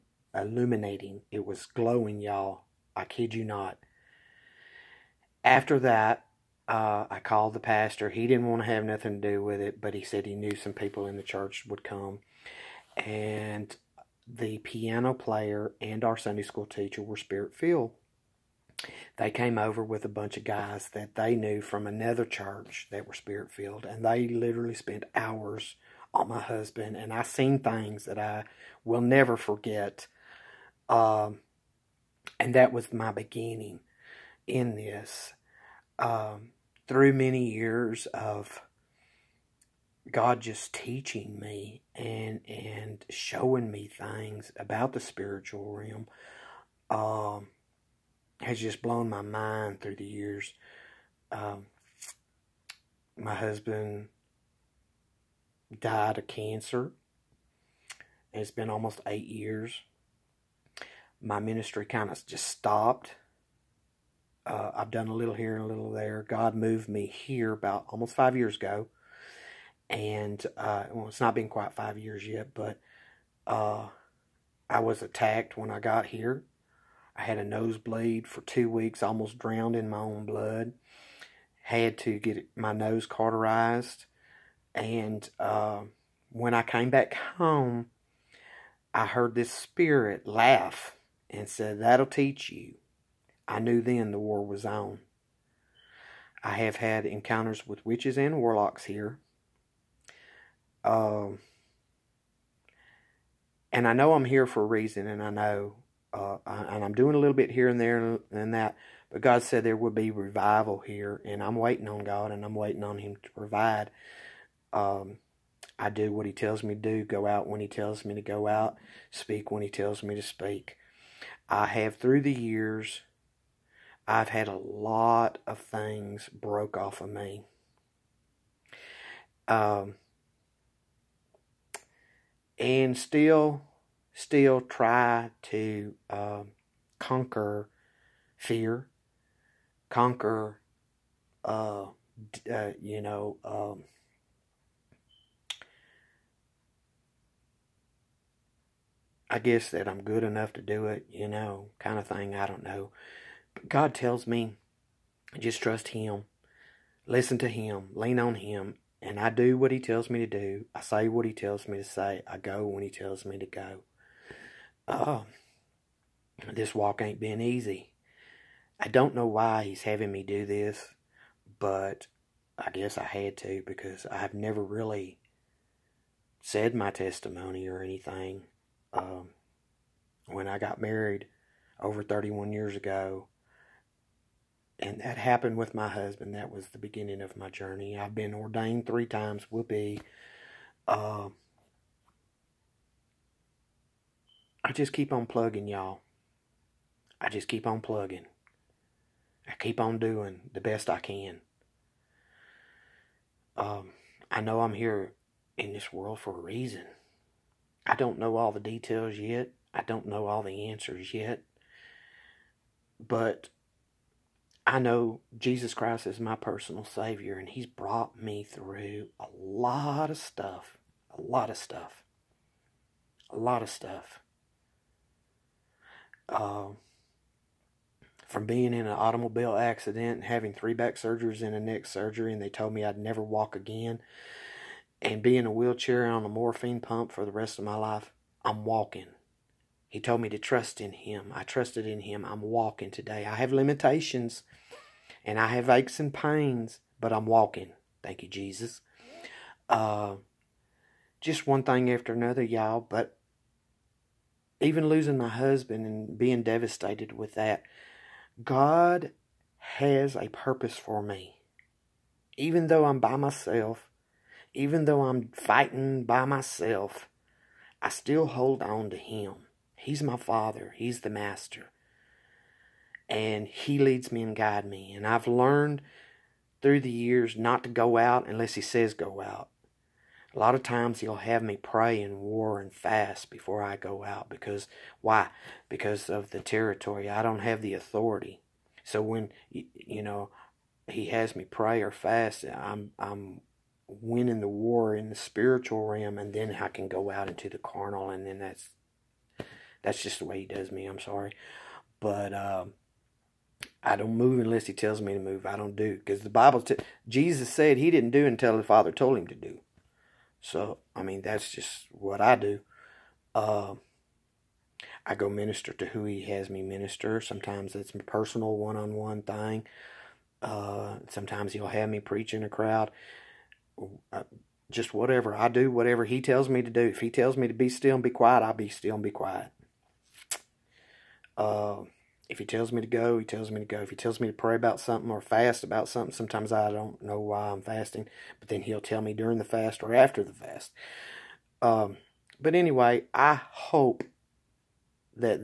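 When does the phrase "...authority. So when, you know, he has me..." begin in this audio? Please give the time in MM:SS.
04:47.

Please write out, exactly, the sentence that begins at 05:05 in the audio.
I don't do because the Bible.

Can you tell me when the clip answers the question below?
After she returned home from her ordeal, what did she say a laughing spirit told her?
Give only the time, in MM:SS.
01:31.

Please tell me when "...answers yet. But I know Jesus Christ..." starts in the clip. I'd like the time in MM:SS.
03:30.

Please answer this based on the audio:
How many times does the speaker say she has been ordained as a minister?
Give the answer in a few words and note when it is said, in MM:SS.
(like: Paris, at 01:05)
3, at 03:08.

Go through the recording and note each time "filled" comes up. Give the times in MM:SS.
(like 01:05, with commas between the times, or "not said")
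00:17, 00:23.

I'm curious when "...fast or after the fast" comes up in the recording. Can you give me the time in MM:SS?
05:39.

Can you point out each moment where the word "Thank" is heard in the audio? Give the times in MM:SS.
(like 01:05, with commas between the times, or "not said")
04:08.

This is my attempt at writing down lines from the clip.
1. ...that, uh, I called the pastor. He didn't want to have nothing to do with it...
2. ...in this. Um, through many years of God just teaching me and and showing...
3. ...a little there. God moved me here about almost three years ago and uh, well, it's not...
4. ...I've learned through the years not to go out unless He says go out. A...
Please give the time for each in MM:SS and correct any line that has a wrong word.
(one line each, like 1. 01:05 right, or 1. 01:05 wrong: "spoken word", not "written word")
1. 00:05 right
2. 00:34 right
3. 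01:05 wrong: "five", not "three"
4. 04:35 right.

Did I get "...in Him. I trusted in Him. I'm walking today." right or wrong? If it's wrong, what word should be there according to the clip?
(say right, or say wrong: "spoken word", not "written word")
right.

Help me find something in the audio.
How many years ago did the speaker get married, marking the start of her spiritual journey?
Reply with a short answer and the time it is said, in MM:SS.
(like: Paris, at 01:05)
31, at 03:02.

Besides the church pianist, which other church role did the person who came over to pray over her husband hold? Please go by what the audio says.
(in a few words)
Sunday school teacher.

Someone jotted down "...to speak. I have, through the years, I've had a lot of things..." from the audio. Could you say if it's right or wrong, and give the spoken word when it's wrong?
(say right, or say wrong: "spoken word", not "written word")
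right.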